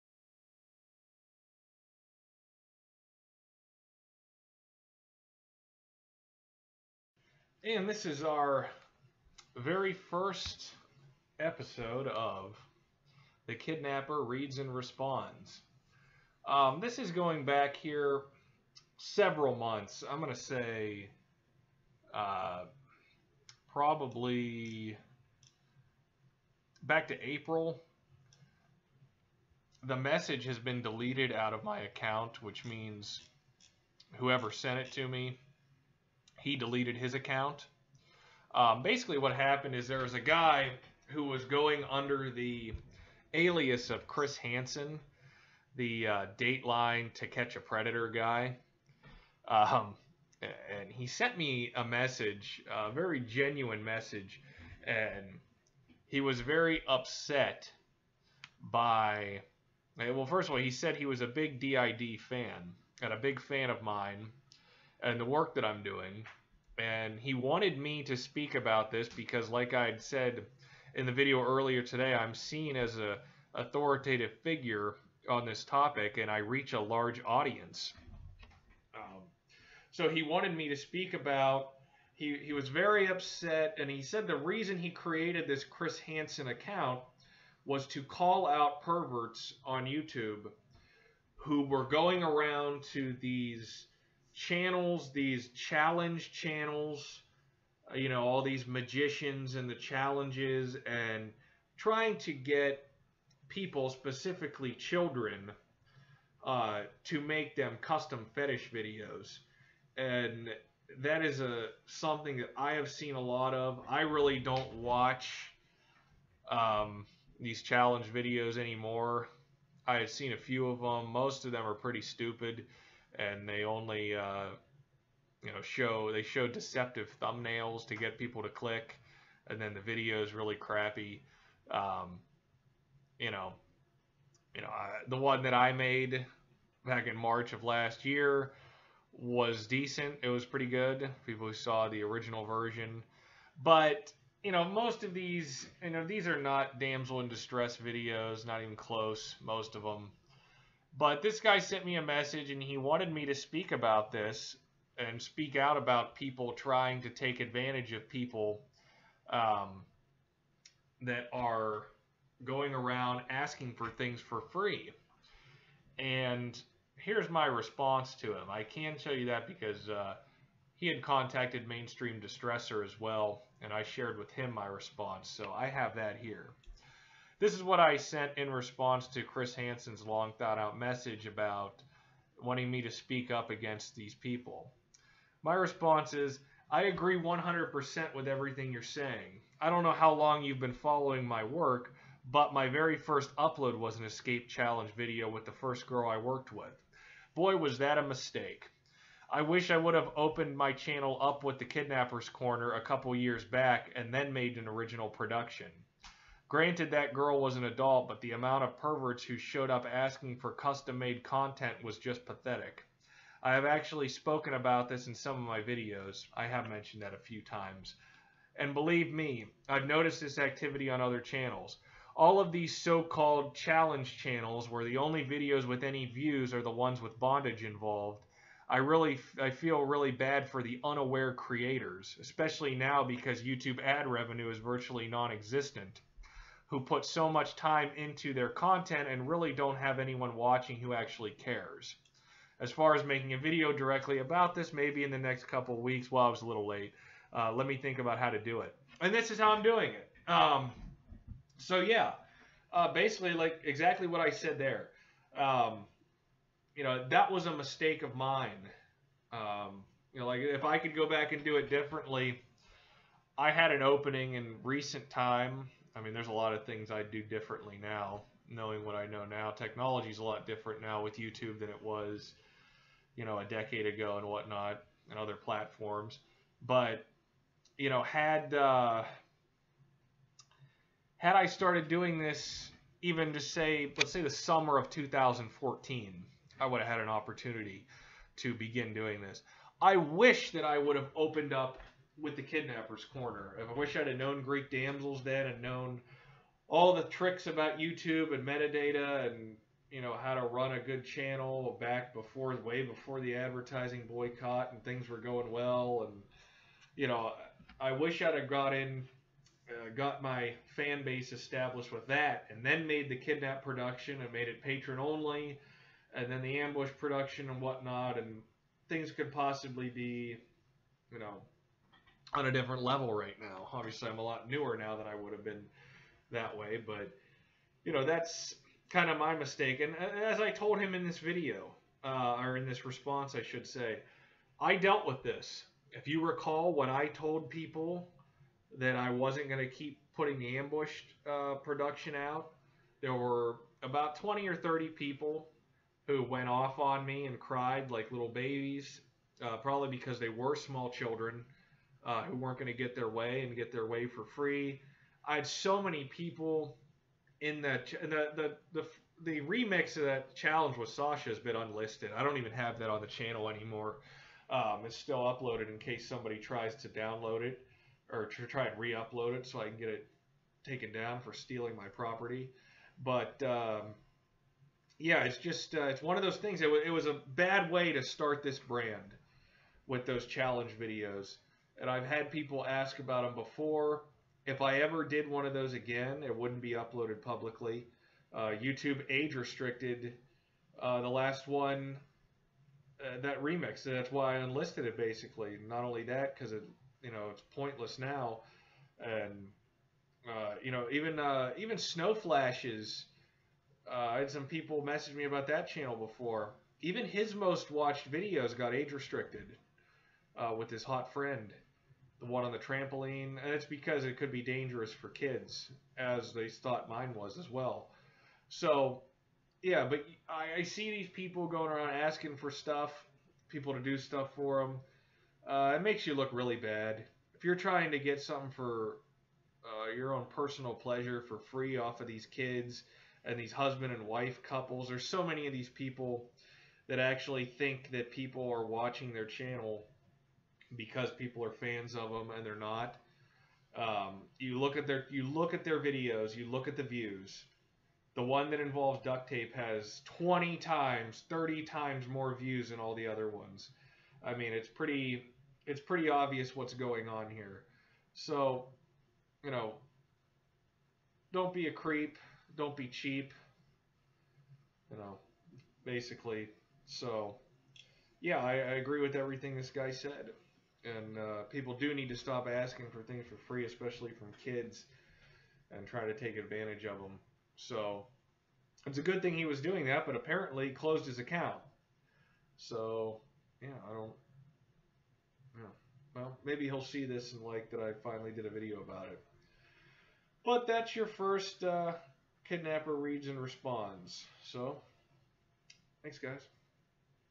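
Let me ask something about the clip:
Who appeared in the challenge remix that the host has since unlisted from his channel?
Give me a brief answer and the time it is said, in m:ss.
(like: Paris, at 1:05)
Sasha, at 6:00.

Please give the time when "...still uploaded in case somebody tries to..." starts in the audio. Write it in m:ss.
6:04.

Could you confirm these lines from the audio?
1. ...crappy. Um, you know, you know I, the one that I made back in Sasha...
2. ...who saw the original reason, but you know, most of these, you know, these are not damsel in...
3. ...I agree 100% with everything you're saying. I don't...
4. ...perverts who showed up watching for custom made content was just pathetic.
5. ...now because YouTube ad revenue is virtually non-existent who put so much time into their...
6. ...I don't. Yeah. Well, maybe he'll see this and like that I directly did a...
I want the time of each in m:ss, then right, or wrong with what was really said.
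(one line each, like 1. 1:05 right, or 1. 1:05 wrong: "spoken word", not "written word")
1. 2:10 wrong: "March", not "Sasha"
2. 2:21 wrong: "version", not "reason"
3. 3:06 right
4. 3:28 wrong: "asking", not "watching"
5. 3:52 right
6. 8:03 wrong: "finally", not "directly".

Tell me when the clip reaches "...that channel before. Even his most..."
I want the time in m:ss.
6:45.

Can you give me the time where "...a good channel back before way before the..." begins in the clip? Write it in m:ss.
5:00.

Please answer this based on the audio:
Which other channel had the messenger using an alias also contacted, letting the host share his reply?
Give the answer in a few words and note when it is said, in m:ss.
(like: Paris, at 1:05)
Mainstream Distressor, at 2:51.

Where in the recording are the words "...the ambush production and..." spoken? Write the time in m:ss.
5:16.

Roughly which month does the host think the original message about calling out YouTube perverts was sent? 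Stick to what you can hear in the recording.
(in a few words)
April.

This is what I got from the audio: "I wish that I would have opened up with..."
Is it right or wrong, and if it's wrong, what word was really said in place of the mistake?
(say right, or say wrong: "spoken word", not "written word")
right.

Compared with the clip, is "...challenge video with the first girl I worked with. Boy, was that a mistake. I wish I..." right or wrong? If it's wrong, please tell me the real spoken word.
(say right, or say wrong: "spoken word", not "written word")
right.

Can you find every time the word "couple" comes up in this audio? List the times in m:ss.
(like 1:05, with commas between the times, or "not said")
3:22, 4:05, 7:14.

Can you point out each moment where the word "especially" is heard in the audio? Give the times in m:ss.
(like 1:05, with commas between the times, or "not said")
3:52, 7:53.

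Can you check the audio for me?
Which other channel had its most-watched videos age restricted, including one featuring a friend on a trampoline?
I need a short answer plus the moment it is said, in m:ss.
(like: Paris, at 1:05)
Snowflashes, at 6:41.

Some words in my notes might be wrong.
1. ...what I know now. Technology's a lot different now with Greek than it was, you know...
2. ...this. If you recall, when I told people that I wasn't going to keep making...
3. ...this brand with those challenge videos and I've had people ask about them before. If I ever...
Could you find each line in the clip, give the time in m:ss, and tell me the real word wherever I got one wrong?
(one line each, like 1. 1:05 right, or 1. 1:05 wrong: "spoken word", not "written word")
1. 4:28 wrong: "YouTube", not "Greek"
2. 5:35 wrong: "putting", not "making"
3. 6:18 right.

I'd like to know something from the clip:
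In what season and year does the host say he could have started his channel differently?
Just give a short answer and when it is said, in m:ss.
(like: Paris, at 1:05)
summer of 2014, at 4:44.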